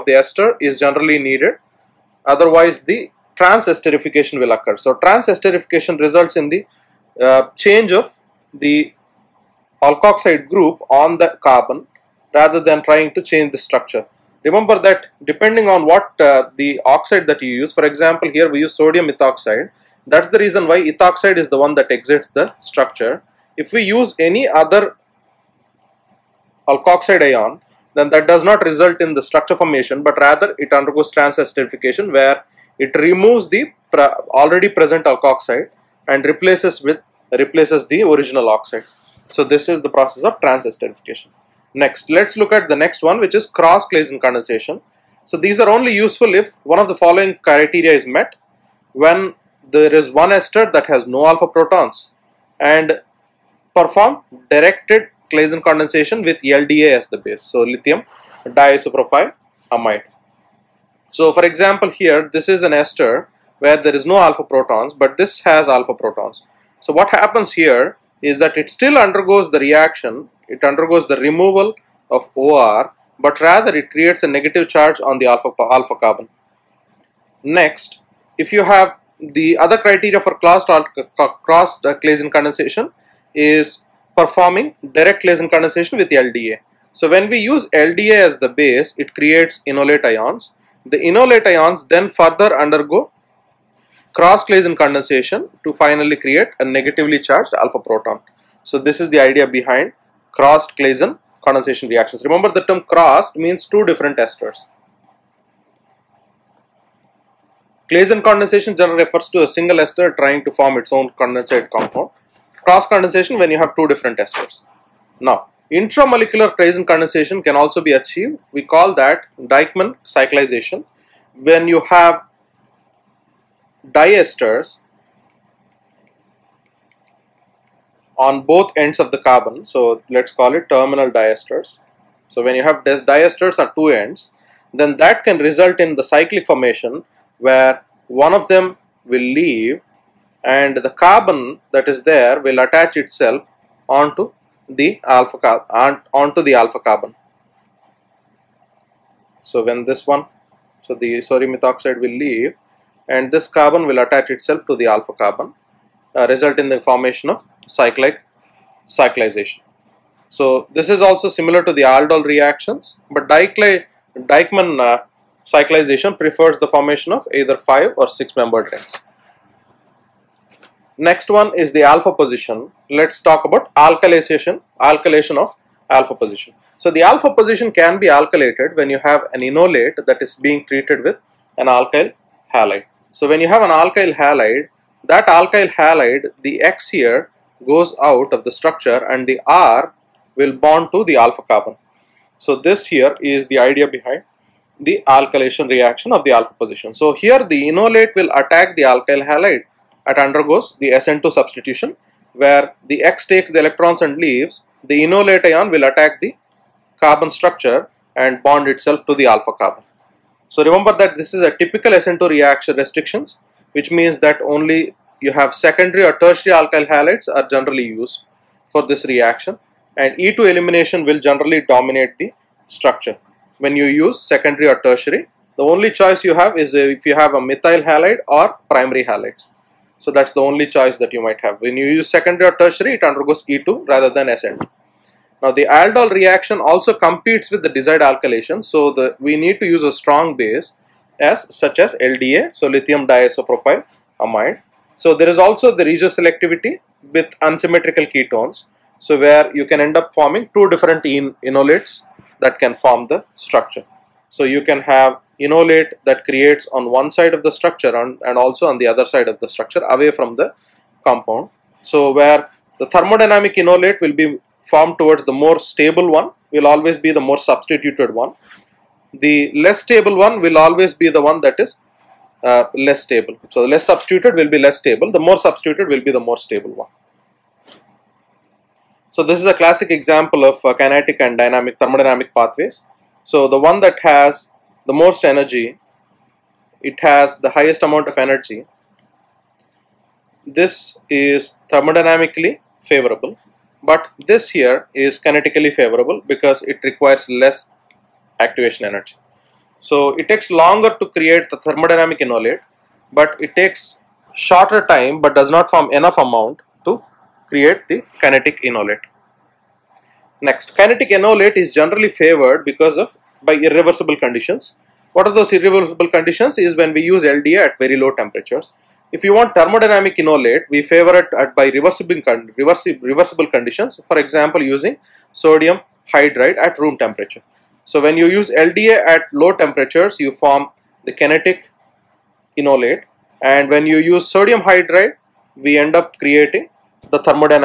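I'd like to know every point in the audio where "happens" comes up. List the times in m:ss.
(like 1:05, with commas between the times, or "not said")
1:07.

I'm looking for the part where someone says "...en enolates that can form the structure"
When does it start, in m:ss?
4:11.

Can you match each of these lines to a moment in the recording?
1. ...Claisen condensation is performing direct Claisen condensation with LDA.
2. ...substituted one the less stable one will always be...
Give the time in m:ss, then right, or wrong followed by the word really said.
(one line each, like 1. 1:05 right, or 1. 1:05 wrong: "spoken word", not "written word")
1. 1:21 right
2. 4:27 right.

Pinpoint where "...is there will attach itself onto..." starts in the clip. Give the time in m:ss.
2:21.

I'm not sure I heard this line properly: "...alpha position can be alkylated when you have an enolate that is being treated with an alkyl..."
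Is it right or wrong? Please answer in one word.
right.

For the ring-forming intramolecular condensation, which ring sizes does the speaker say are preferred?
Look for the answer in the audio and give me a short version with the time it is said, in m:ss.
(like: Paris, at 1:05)
5 or 6 membered, at 2:47.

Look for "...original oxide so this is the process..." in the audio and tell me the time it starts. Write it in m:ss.
0:38.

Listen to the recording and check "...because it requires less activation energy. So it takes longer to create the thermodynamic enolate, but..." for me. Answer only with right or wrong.
right.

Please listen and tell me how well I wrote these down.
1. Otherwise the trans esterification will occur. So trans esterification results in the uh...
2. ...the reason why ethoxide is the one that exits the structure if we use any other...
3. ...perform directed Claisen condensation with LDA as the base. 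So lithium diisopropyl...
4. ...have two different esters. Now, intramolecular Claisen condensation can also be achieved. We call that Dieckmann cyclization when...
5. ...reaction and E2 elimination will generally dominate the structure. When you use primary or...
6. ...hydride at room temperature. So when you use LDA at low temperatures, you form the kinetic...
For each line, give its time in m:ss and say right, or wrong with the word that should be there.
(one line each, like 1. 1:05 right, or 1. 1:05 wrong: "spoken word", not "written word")
1. 0:02 right
2. 0:20 right
3. 0:53 right
4. 1:53 right
5. 3:39 wrong: "secondary", not "primary"
6. 5:26 right.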